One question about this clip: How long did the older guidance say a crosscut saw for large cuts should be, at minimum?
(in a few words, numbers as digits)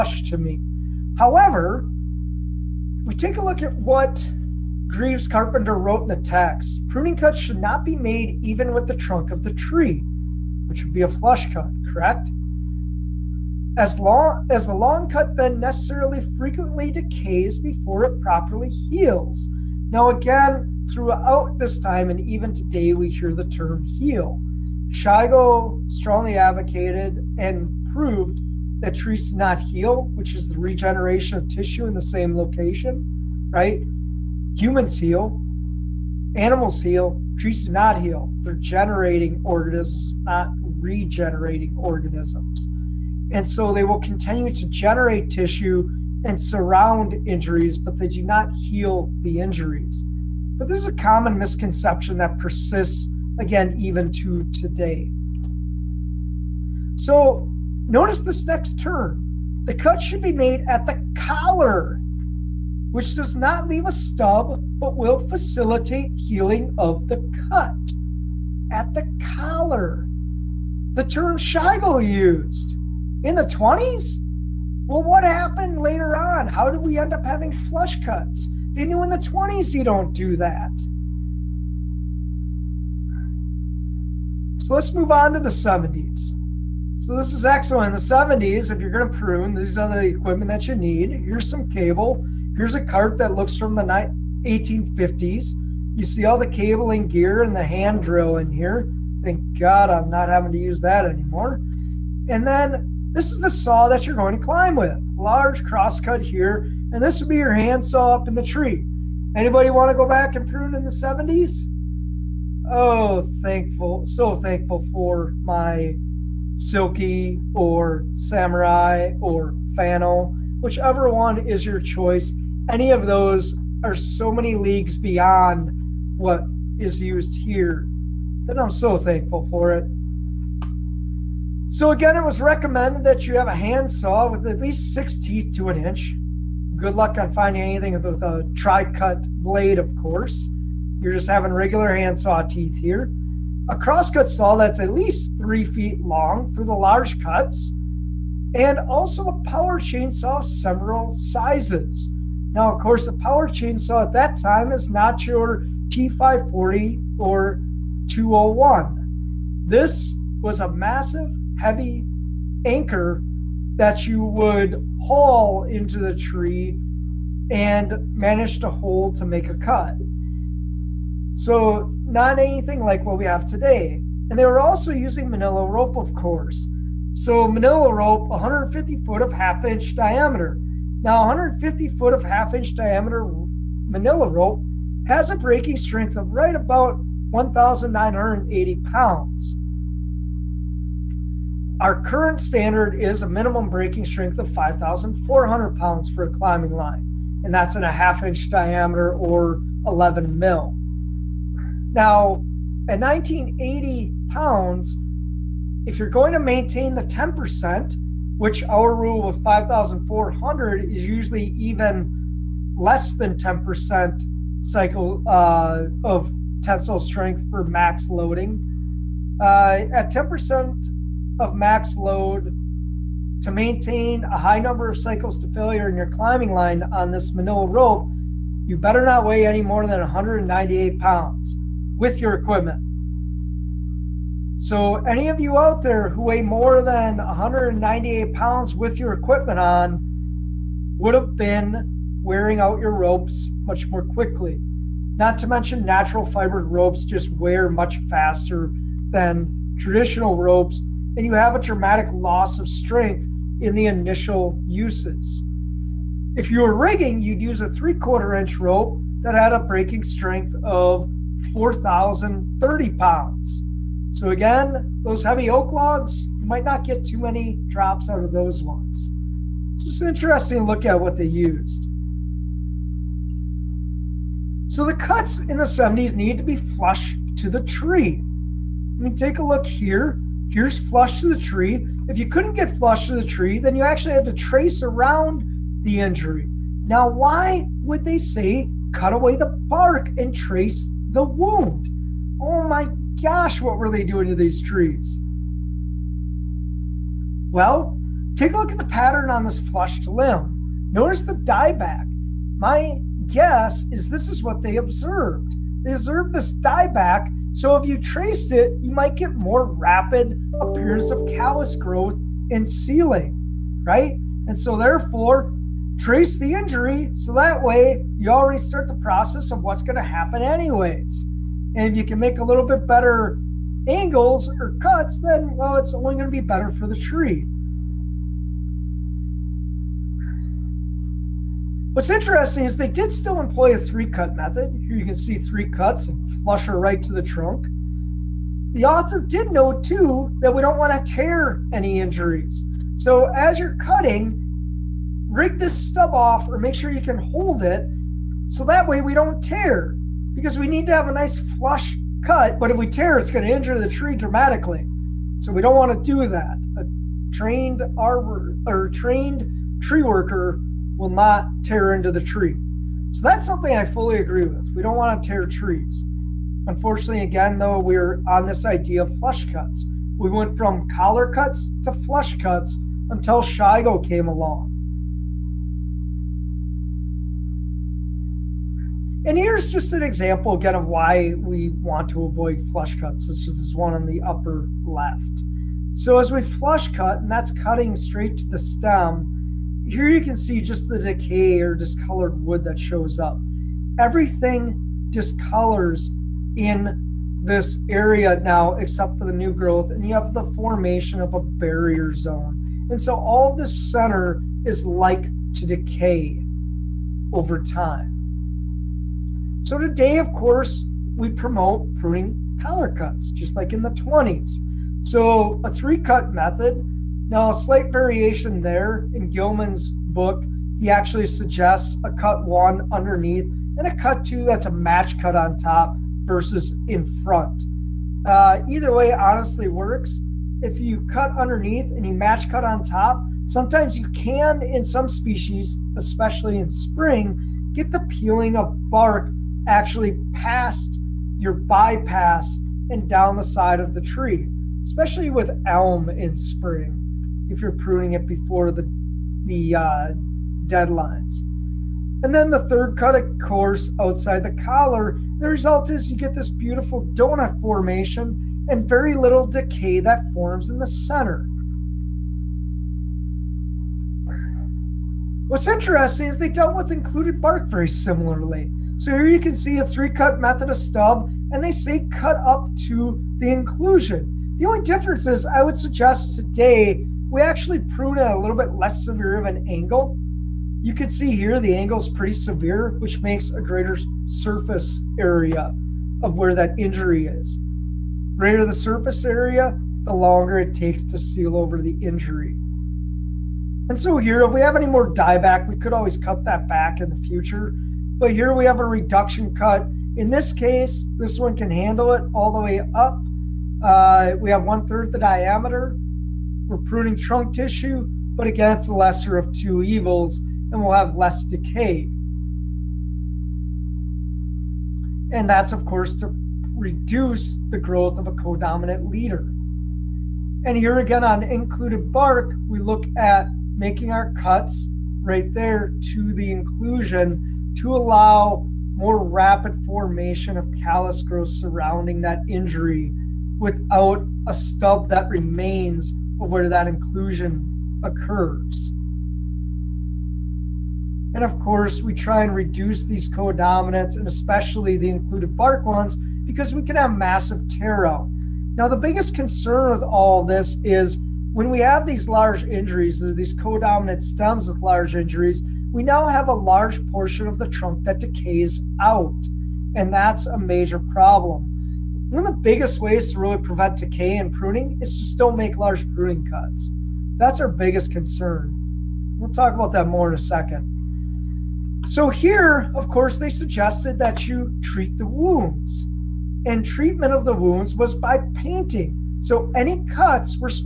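3 feet.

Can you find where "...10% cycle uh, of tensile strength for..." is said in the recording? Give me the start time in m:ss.
3:33.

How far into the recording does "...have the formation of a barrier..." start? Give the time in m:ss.
6:40.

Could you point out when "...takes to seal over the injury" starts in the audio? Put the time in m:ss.
8:10.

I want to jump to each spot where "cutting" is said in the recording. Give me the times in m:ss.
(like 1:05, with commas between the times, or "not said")
5:43, 6:27.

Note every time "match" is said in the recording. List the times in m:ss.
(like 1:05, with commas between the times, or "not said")
7:04, 7:12.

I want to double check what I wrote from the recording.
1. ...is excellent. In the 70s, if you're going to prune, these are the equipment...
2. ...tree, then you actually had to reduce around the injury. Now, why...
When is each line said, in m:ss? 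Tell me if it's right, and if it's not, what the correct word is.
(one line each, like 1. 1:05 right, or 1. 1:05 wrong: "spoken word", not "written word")
1. 1:27 right
2. 4:43 wrong: "trace", not "reduce".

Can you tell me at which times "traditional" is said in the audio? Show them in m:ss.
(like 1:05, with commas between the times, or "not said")
4:09.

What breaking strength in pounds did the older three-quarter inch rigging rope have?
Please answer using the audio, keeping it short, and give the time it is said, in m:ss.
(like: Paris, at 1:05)
4,030 pounds, at 4:21.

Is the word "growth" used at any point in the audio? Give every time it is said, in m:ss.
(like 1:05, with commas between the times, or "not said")
5:11, 6:39, 8:37, 8:51.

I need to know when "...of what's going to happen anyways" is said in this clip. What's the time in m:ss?
5:19.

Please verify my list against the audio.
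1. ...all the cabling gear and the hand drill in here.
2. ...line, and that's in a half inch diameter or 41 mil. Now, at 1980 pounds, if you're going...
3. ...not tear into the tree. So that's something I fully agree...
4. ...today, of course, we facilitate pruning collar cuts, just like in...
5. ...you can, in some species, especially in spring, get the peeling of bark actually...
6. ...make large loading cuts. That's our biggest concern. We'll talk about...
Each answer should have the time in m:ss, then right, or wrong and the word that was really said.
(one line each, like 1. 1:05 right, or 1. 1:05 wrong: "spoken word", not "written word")
1. 1:36 right
2. 3:16 wrong: "11", not "41"
3. 6:01 right
4. 6:49 wrong: "promote", not "facilitate"
5. 7:13 right
6. 9:25 wrong: "pruning", not "loading".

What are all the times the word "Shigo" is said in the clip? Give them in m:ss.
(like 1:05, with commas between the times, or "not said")
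0:24, 6:13.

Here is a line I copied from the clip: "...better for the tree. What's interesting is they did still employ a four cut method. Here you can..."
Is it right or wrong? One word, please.
wrong.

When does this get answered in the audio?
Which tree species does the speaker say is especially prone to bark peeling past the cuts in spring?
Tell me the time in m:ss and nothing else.
7:25.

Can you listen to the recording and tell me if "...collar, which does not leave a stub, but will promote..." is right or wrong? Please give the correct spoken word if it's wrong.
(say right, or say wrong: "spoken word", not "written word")
wrong: "facilitate", not "promote".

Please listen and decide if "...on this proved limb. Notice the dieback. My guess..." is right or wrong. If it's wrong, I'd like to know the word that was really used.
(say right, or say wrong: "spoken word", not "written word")
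wrong: "flushed", not "proved".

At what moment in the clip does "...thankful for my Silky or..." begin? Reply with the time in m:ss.
1:54.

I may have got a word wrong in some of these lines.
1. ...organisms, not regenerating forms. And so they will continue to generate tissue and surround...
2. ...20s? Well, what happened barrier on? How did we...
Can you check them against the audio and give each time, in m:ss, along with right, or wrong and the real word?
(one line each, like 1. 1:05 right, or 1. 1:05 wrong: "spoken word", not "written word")
1. 0:39 wrong: "organisms", not "forms"
2. 1:13 wrong: "later", not "barrier".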